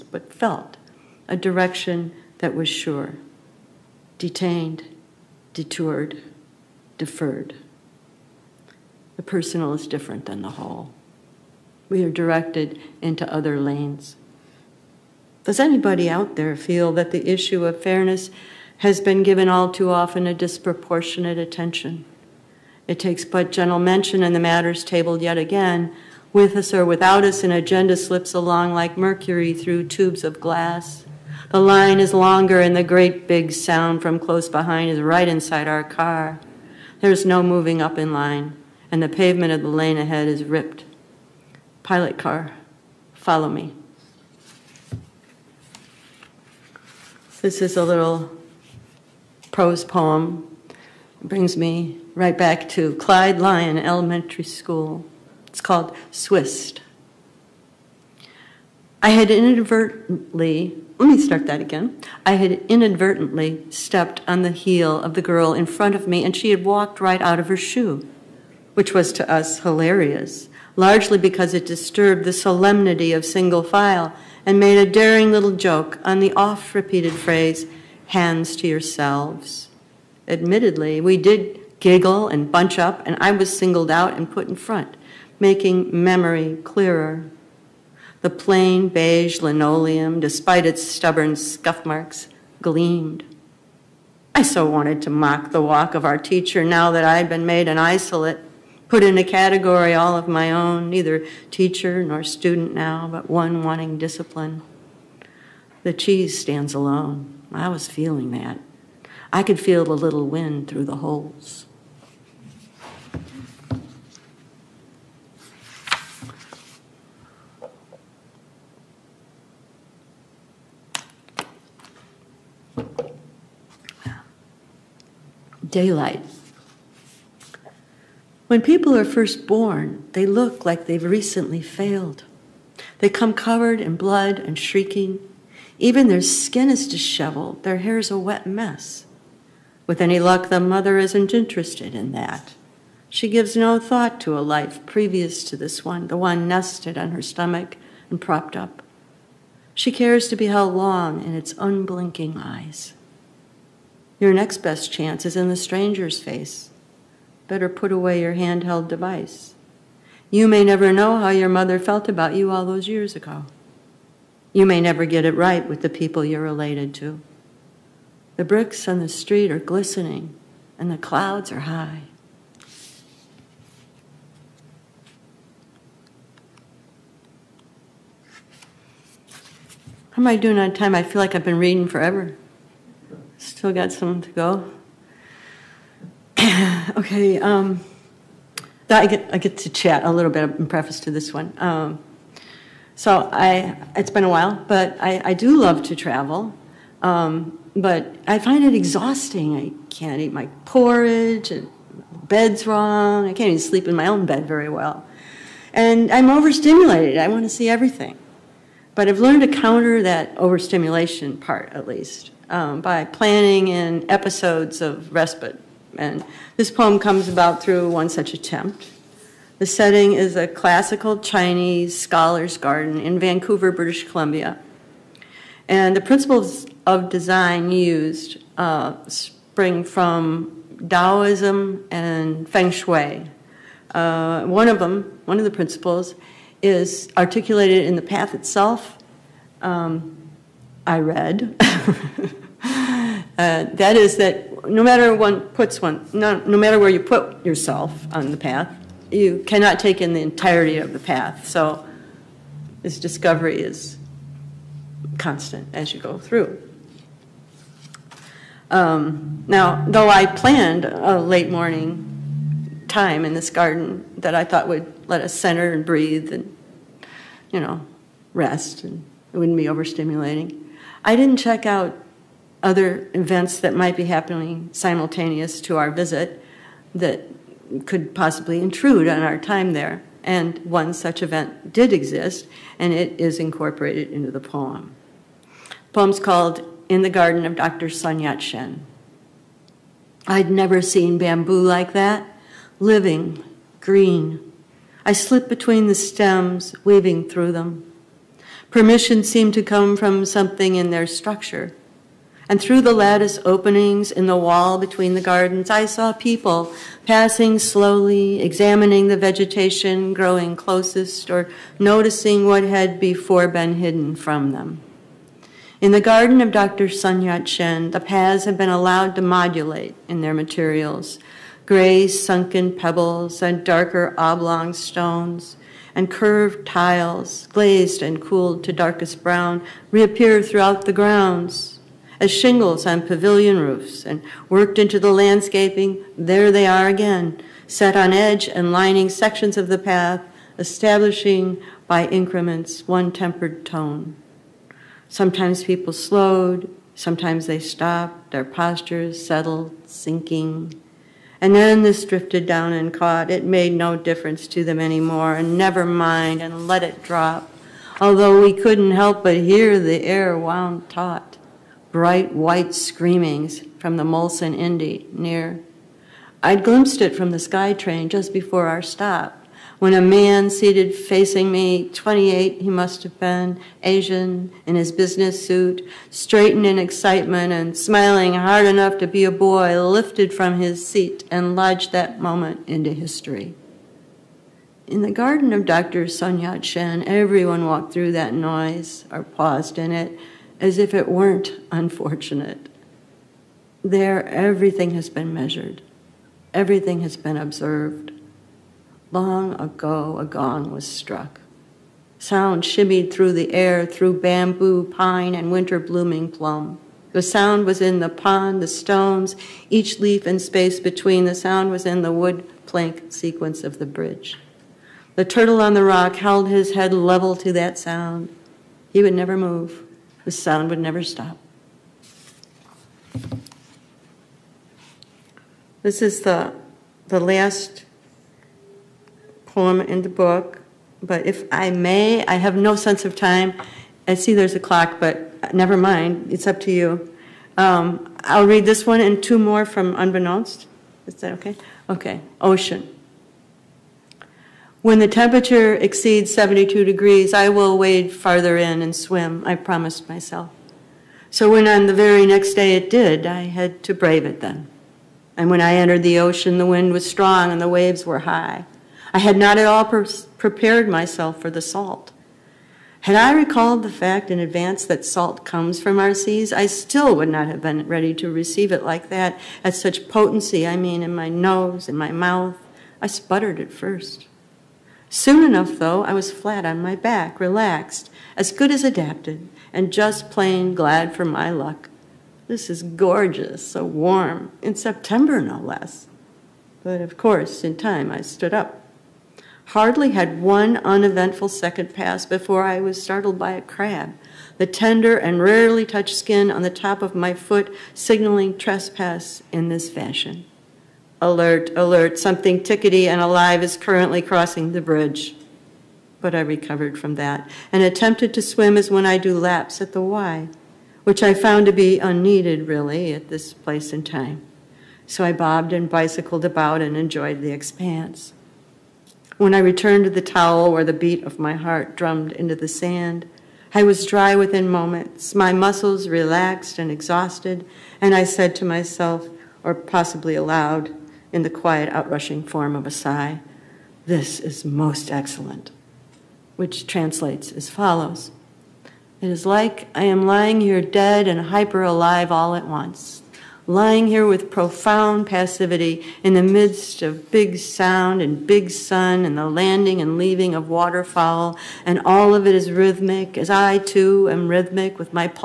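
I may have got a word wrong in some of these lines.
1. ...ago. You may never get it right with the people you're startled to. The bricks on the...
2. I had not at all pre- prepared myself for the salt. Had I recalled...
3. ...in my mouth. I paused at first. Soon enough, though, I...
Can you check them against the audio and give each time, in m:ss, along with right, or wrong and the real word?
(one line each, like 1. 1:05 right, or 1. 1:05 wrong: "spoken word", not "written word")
1. 2:43 wrong: "related", not "startled"
2. 7:39 right
3. 7:51 wrong: "sputtered", not "paused".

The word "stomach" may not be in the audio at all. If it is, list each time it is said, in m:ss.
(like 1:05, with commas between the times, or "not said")
2:27.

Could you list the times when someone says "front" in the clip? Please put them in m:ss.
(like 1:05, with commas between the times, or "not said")
1:05, 1:24.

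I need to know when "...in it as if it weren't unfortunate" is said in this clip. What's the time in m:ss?
6:29.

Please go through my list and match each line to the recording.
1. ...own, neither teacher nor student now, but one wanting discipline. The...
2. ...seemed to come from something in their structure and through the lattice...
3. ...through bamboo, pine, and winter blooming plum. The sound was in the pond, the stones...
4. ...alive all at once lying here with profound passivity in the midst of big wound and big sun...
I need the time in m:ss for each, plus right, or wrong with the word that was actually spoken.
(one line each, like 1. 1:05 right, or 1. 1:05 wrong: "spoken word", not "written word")
1. 1:40 right
2. 4:59 right
3. 6:43 right
4. 9:01 wrong: "sound", not "wound".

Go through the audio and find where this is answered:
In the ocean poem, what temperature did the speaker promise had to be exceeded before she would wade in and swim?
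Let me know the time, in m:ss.
7:26.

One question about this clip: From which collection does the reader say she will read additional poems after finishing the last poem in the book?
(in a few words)
Unbeknownst.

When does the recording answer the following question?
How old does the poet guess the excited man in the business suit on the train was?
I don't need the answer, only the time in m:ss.
6:11.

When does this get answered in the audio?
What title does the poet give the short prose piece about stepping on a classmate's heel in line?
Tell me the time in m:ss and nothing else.
0:56.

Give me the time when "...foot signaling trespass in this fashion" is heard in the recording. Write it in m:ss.
8:17.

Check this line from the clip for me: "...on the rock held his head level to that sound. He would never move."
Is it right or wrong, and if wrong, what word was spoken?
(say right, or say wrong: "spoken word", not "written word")
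right.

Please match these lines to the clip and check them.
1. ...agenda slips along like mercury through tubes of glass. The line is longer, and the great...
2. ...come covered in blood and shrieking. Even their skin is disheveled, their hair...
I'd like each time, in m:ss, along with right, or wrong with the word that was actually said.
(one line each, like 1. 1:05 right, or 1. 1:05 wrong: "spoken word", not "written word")
1. 0:27 right
2. 2:13 right.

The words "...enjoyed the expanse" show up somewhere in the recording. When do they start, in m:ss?
8:36.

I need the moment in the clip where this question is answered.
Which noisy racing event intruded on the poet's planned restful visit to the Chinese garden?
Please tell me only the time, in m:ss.
6:04.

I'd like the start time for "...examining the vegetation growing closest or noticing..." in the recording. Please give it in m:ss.
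5:08.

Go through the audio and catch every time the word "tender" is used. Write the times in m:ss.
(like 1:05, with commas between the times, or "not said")
8:14.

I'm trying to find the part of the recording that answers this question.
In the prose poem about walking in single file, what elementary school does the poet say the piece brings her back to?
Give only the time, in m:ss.
0:52.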